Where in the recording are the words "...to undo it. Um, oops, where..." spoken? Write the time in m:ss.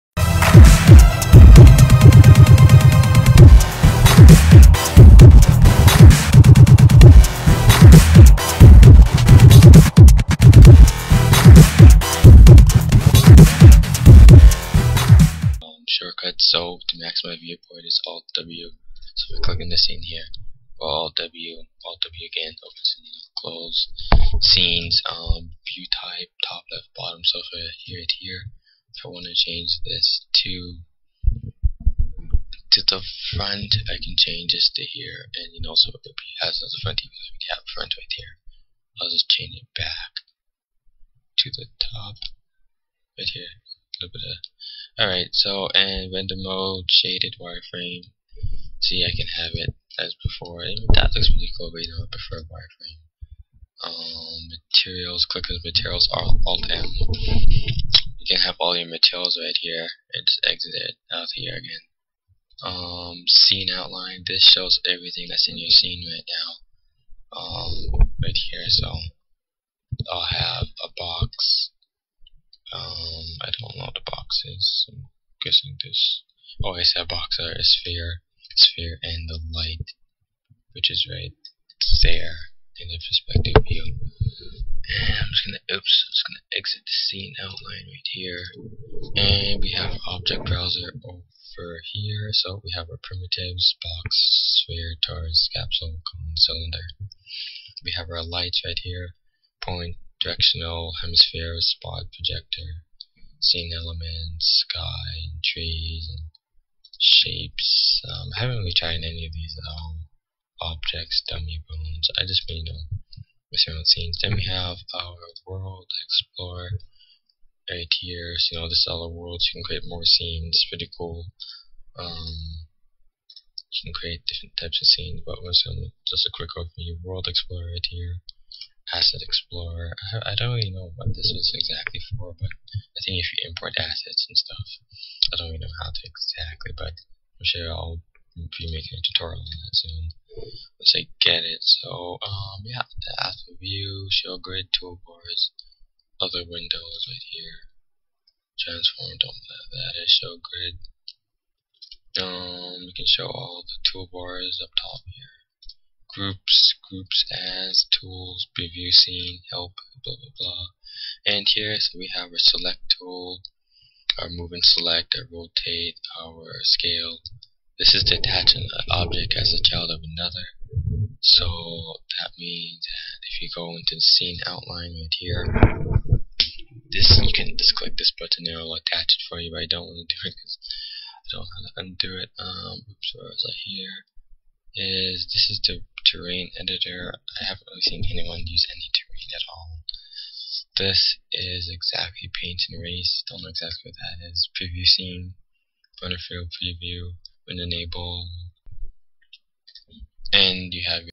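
3:01.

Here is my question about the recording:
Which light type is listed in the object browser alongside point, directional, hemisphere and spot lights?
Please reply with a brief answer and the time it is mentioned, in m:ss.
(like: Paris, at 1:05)
Projector, at 1:42.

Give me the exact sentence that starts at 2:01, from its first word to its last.
Um, you can create different types of scenes, but we're just a quick overview.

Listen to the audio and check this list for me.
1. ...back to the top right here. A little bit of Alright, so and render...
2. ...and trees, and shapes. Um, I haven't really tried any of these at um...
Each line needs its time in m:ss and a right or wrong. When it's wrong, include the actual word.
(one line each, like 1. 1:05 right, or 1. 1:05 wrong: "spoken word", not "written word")
1. 0:39 right
2. 1:45 right.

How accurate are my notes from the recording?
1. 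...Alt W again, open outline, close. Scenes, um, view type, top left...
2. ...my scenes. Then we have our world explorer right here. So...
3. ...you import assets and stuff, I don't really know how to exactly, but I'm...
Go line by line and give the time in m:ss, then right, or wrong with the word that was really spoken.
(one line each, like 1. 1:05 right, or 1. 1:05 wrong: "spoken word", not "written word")
1. 0:21 wrong: "scene", not "outline"
2. 1:53 right
3. 2:13 right.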